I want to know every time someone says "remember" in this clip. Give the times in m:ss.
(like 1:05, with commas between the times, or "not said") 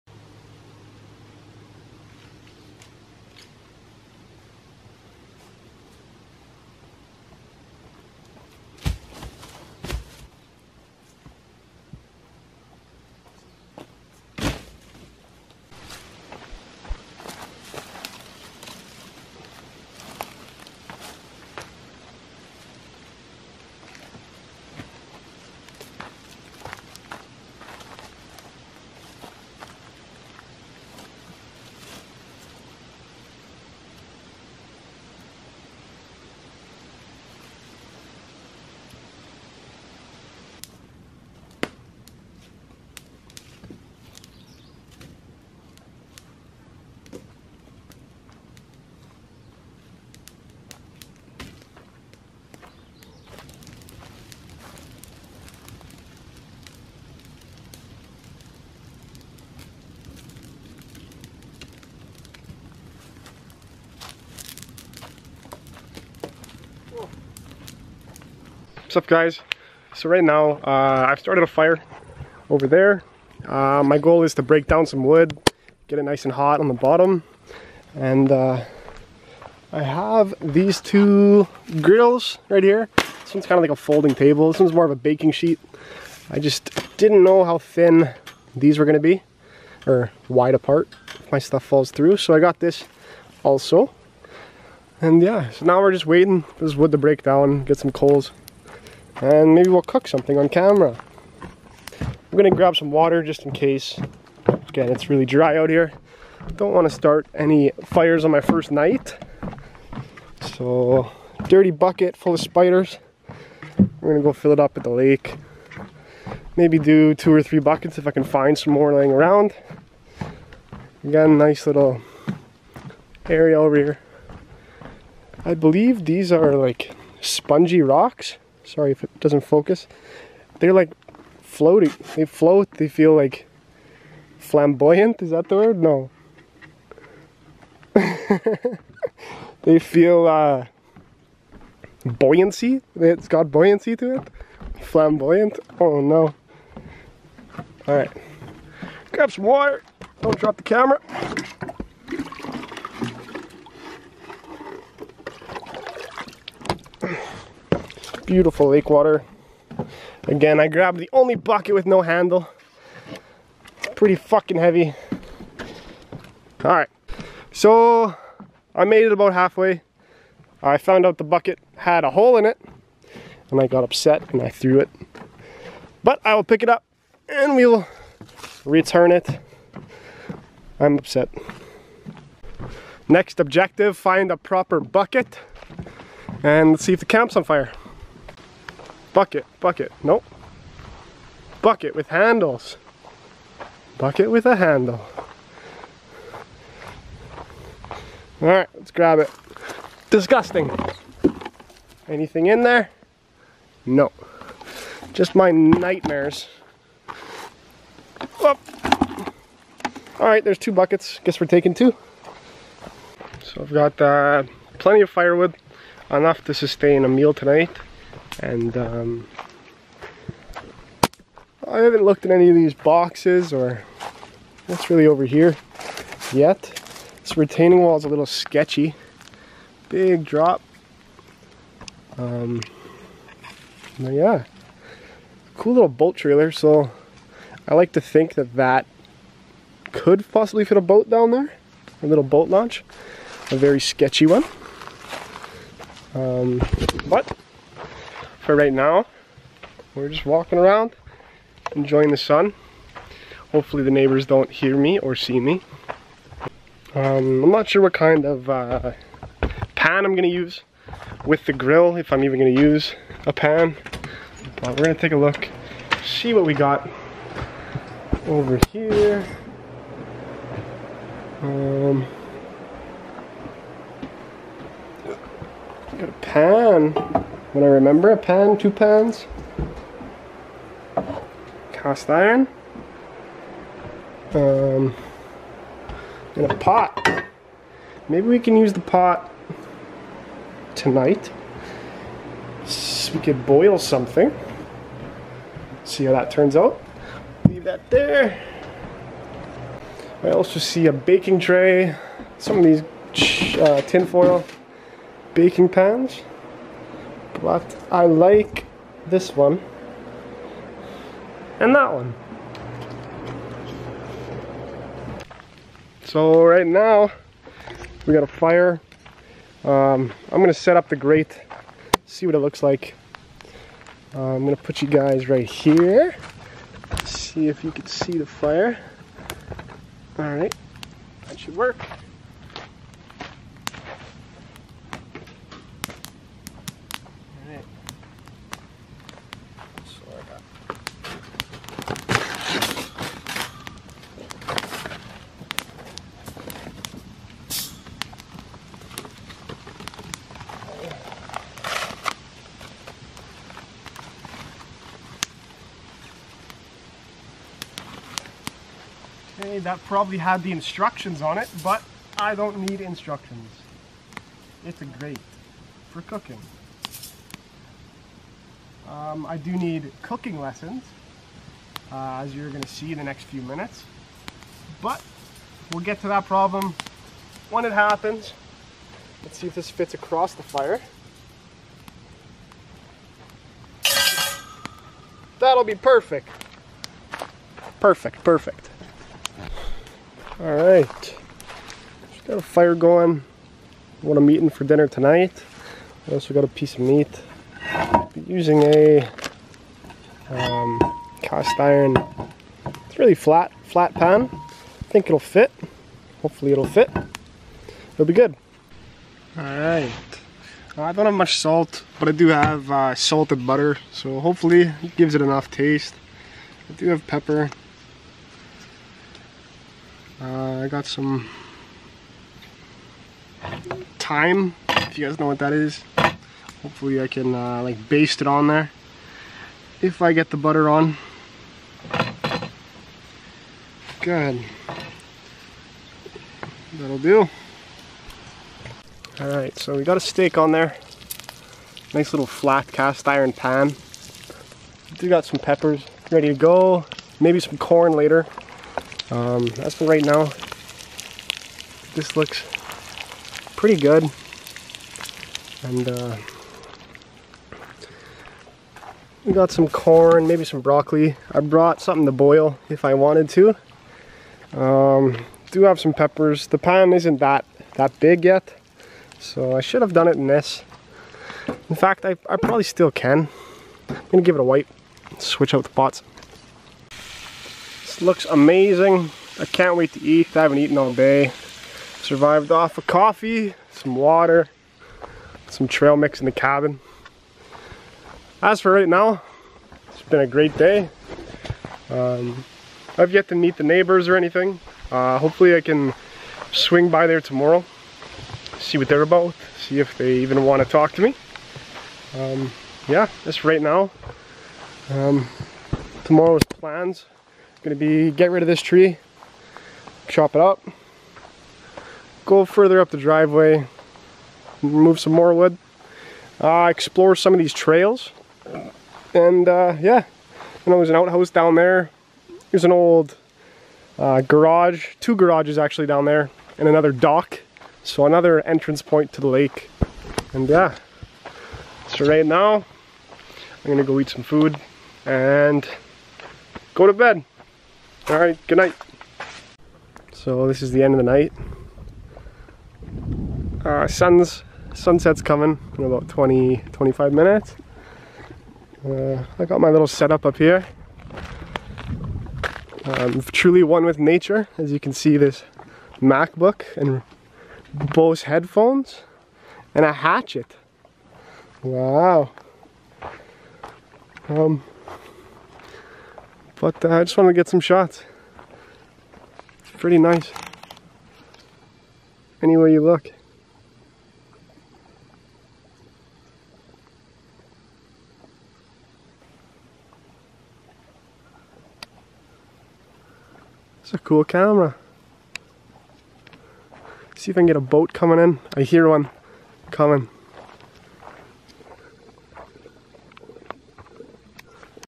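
4:37.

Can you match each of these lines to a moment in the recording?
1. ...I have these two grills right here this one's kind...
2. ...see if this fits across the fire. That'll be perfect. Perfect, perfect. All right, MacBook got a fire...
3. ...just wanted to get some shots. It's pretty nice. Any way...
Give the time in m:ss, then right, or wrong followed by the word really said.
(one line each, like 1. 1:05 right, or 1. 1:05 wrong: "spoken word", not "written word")
1. 1:19 right
2. 6:19 wrong: "Just", not "MacBook"
3. 9:27 right.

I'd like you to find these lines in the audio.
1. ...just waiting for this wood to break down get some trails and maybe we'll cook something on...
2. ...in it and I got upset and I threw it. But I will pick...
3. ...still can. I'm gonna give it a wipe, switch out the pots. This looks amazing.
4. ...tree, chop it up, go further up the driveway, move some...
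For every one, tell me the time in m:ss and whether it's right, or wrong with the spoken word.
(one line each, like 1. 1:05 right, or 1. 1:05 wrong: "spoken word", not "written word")
1. 1:35 wrong: "coals", not "trails"
2. 2:52 right
3. 7:52 right
4. 8:28 right.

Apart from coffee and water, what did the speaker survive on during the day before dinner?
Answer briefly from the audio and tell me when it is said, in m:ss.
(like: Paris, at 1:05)
Trail mix, at 8:05.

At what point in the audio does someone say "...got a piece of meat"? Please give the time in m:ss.
6:36.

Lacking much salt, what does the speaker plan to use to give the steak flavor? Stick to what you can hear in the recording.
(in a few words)
Salted butter.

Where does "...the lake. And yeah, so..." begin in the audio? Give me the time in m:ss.
8:49.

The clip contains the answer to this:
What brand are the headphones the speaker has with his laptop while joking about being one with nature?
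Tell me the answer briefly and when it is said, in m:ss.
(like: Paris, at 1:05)
Bose, at 9:17.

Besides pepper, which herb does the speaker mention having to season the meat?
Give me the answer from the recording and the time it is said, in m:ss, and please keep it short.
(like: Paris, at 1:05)
Thyme, at 7:03.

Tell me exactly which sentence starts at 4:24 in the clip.
But we're gonna take a look, see what we got over here.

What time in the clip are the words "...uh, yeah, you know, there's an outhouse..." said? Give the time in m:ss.
8:39.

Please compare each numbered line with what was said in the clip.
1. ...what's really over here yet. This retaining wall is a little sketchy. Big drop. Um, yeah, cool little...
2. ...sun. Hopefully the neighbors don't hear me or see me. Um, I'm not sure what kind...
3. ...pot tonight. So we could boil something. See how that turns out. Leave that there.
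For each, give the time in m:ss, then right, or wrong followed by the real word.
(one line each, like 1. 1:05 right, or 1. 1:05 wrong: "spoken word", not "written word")
1. 3:44 right
2. 4:12 right
3. 4:48 right.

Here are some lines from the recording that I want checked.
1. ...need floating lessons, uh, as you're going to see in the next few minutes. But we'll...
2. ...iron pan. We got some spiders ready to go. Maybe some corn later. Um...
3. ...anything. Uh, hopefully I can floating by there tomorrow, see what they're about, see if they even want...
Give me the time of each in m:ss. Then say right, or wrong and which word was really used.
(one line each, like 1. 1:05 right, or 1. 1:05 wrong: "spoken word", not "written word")
1. 6:09 wrong: "cooking", not "floating"
2. 7:23 wrong: "peppers", not "spiders"
3. 8:14 wrong: "swing", not "floating".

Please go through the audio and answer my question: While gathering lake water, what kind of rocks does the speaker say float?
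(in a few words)
Spongy rocks.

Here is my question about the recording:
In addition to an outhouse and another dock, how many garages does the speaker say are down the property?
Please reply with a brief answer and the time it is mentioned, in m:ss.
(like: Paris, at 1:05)
2, at 8:44.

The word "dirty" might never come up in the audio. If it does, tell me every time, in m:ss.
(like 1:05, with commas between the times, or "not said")
1:51.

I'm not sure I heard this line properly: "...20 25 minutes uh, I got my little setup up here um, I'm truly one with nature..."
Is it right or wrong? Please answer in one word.
right.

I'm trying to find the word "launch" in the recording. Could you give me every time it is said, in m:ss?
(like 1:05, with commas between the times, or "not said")
4:02.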